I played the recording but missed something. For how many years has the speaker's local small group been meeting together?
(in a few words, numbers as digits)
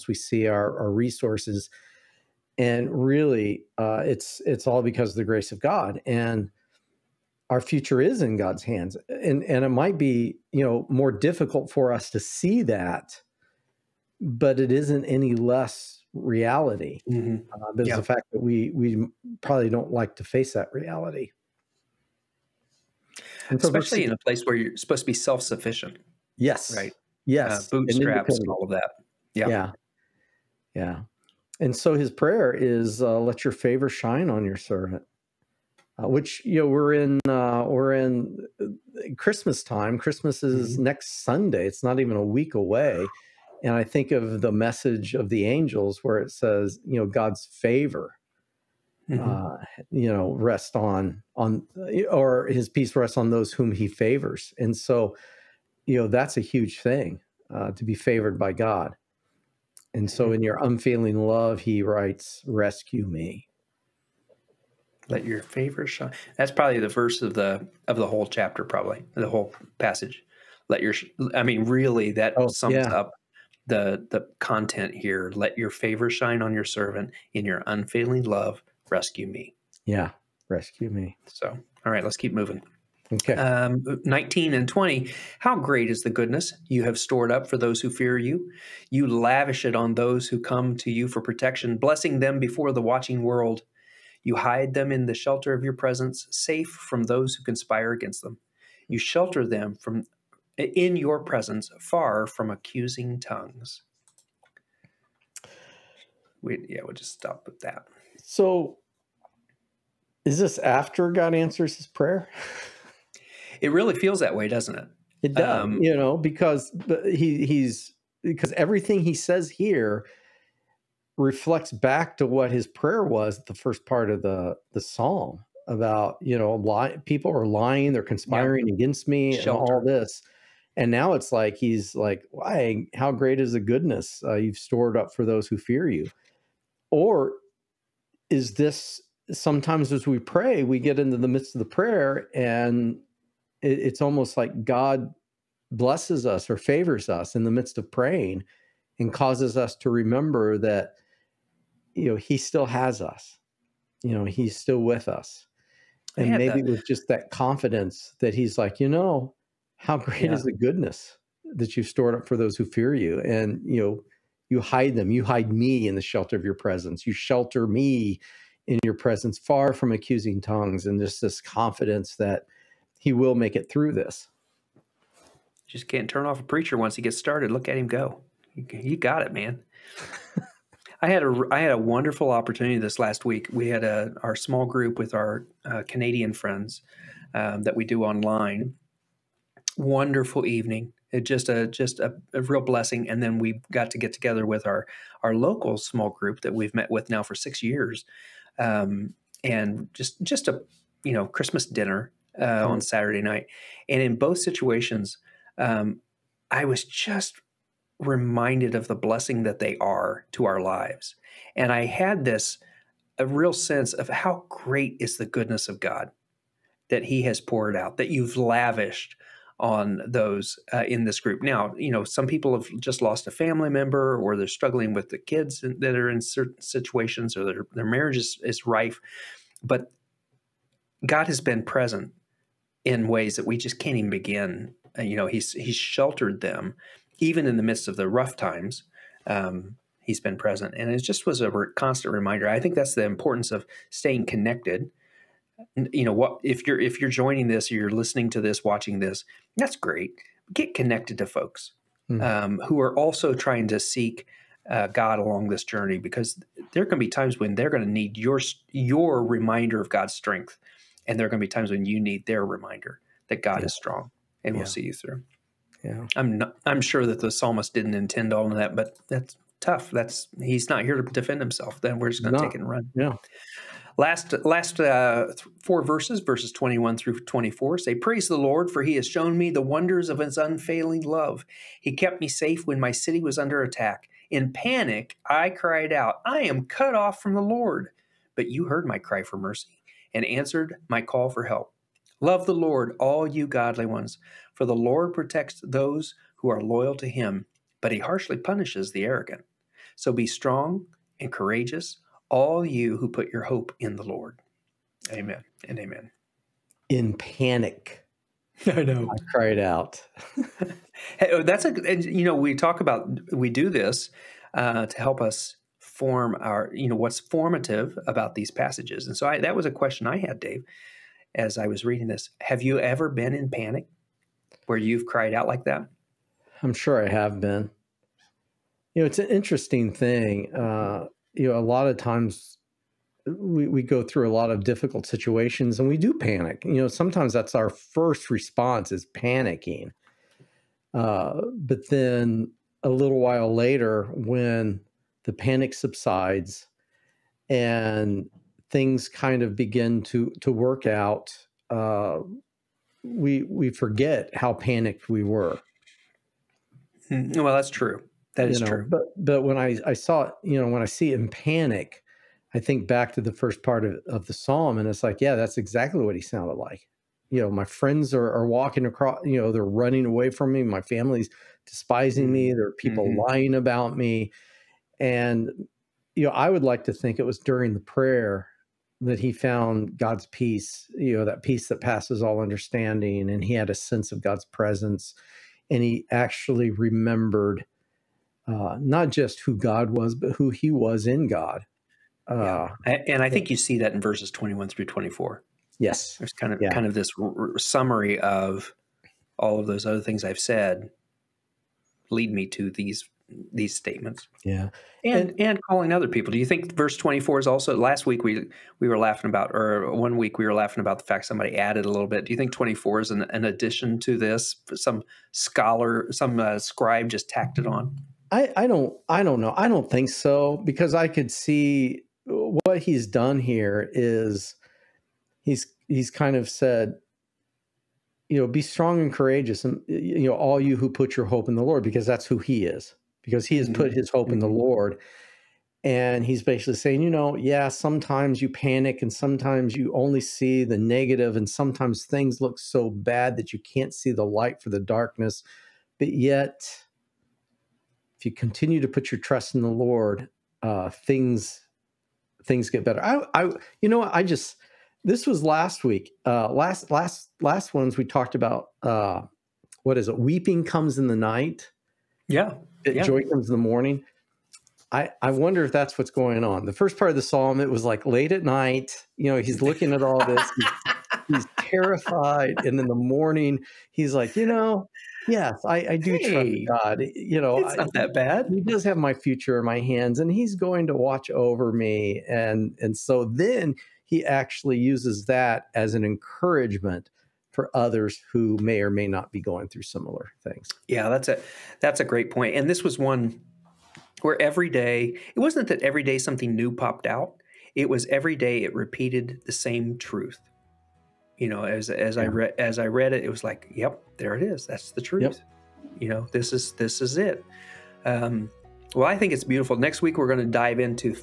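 6.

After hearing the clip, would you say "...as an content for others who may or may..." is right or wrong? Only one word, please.
wrong.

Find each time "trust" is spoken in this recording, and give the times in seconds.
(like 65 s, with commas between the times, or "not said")
449 s, 476 s.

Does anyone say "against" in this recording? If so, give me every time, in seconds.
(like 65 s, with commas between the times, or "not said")
97 s, 128 s.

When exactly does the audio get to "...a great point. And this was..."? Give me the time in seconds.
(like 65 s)
492 s.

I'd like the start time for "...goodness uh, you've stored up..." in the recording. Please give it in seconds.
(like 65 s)
133 s.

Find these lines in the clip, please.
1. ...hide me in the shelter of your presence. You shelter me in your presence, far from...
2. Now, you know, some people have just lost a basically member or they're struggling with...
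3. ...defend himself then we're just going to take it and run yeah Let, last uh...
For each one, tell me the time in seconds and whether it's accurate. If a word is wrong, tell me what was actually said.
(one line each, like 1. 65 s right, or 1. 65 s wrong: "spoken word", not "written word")
1. 165 s right
2. 221 s wrong: "family", not "basically"
3. 271 s wrong: "Last", not "Let".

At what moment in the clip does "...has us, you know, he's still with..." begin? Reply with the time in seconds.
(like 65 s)
152 s.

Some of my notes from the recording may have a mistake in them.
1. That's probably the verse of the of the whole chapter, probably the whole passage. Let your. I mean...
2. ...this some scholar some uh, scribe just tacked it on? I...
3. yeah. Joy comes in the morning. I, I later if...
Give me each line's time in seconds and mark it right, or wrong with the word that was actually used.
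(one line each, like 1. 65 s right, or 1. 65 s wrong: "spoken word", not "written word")
1. 66 s right
2. 414 s right
3. 462 s wrong: "wonder", not "later".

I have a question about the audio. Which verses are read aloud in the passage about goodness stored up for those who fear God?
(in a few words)
19 and 20.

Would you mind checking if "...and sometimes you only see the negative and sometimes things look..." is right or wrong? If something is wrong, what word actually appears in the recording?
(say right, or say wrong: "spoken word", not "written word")
right.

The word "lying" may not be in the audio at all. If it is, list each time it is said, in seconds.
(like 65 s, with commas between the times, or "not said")
127 s, 373 s.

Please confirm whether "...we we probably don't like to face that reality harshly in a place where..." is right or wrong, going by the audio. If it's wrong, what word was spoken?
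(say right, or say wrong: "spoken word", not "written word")
wrong: "especially", not "harshly".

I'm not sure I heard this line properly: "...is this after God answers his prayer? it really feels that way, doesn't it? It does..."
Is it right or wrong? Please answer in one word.
right.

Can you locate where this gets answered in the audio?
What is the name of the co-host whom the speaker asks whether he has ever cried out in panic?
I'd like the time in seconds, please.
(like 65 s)
320 s.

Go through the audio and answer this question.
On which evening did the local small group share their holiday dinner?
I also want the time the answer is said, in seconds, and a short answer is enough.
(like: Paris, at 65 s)
Saturday, at 202 s.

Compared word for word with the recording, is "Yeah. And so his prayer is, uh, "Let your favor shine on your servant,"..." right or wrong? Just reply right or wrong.
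right.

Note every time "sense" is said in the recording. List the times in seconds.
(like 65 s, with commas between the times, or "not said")
213 s, 383 s.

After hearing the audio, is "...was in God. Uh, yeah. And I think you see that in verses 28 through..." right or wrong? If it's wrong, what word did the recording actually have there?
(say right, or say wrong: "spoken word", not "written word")
wrong: "21", not "28".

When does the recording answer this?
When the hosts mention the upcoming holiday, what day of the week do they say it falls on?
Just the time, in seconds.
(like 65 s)
40 s.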